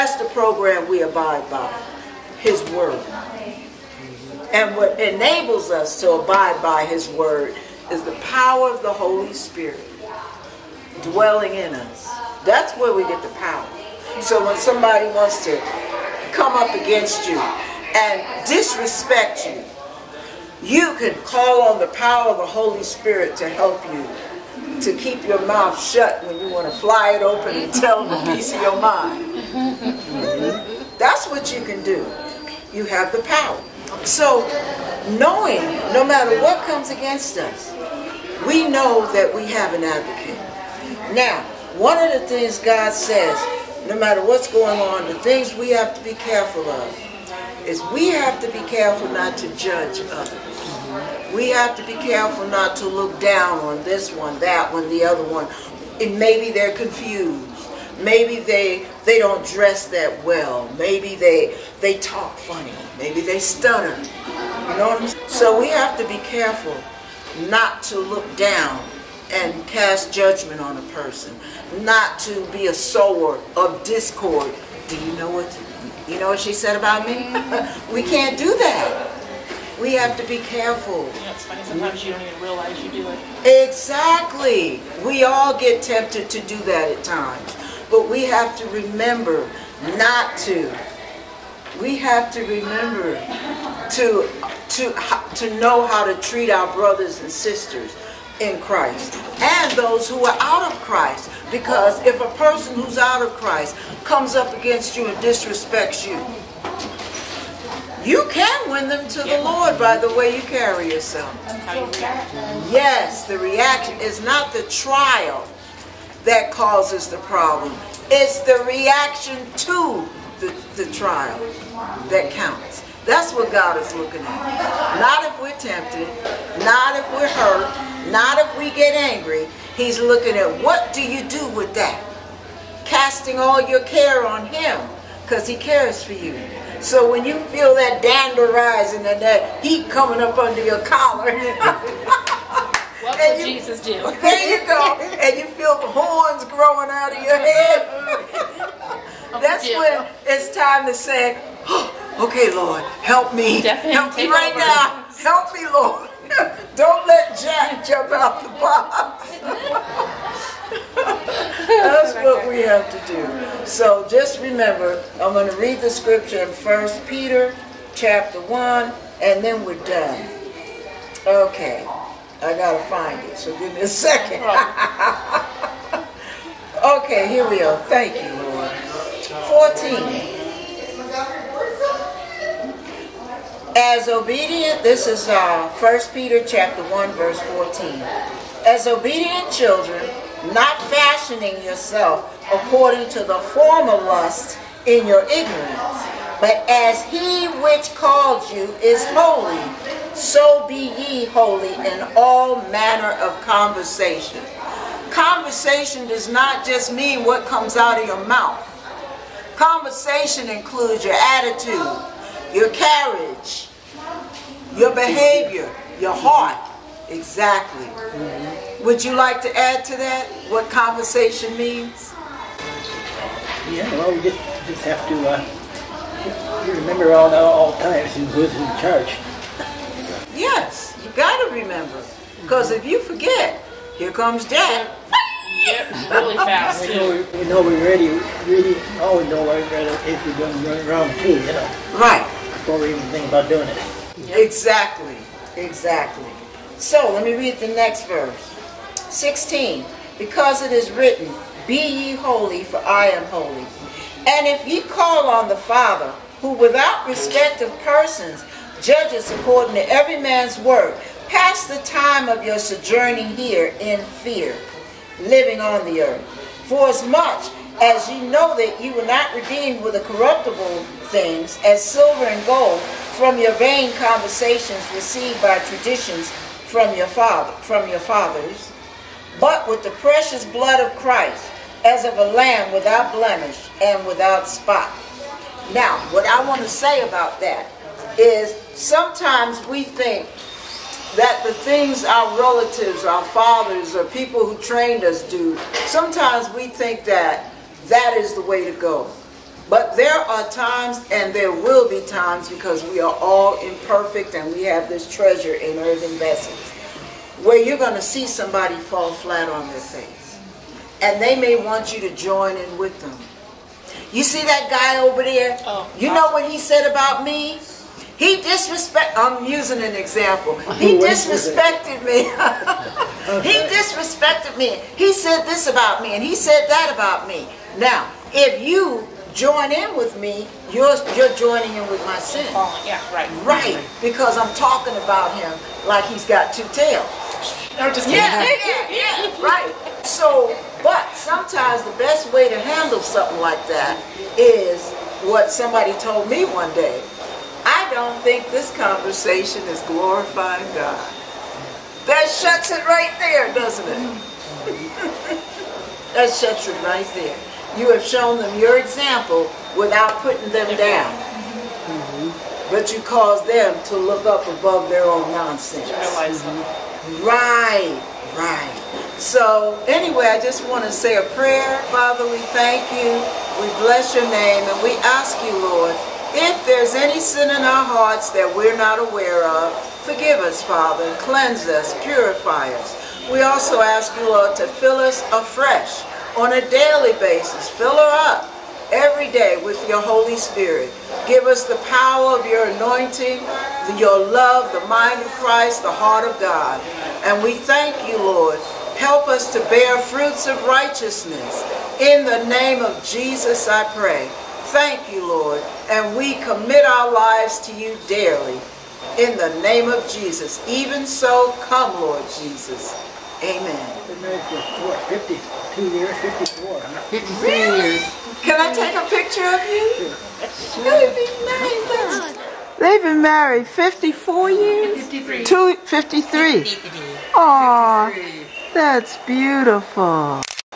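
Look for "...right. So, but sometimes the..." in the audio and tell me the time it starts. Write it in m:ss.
5:39.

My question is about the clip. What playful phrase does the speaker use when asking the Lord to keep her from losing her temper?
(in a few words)
Don't let Jack jump out the box.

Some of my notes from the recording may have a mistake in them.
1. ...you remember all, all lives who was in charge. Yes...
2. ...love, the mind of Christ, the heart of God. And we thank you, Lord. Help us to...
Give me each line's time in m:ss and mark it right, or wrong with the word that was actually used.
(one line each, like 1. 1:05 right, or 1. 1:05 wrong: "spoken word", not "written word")
1. 3:46 wrong: "times", not "lives"
2. 6:34 right.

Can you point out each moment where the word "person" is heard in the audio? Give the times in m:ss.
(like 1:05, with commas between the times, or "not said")
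1:10, 1:42, 4:17.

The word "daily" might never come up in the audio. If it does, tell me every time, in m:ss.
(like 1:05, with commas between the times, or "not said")
6:26, 6:48.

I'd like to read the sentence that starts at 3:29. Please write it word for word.
Conversation includes your attitude, your carriage, your behavior, your heart.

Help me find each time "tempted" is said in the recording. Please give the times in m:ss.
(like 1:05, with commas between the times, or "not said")
1:25, 2:05.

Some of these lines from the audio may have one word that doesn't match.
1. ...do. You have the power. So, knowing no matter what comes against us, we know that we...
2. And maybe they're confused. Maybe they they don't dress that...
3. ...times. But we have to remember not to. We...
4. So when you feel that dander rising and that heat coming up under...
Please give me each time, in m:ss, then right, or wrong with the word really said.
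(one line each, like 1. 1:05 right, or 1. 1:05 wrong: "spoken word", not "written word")
1. 0:31 right
2. 0:56 right
3. 1:27 right
4. 2:16 right.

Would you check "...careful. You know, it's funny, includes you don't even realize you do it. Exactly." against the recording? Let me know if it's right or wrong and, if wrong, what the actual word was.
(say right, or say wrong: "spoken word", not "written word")
wrong: "sometimes", not "includes".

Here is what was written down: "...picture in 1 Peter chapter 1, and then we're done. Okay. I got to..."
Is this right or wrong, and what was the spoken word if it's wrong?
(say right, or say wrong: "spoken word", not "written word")
wrong: "scripture", not "picture".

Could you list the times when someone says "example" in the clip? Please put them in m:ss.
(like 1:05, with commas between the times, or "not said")
5:19, 5:58.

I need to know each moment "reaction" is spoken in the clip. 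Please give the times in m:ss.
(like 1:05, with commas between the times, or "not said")
1:53, 1:58.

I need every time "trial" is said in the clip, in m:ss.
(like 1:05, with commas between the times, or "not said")
1:54, 2:00.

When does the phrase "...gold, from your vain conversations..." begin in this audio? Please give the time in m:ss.
4:32.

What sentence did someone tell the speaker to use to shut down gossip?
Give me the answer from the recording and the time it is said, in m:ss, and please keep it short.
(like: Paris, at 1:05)
I don't think this conversation is glorifying God, at 5:47.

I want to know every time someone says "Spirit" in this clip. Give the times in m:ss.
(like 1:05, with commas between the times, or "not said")
0:09, 0:22, 6:30.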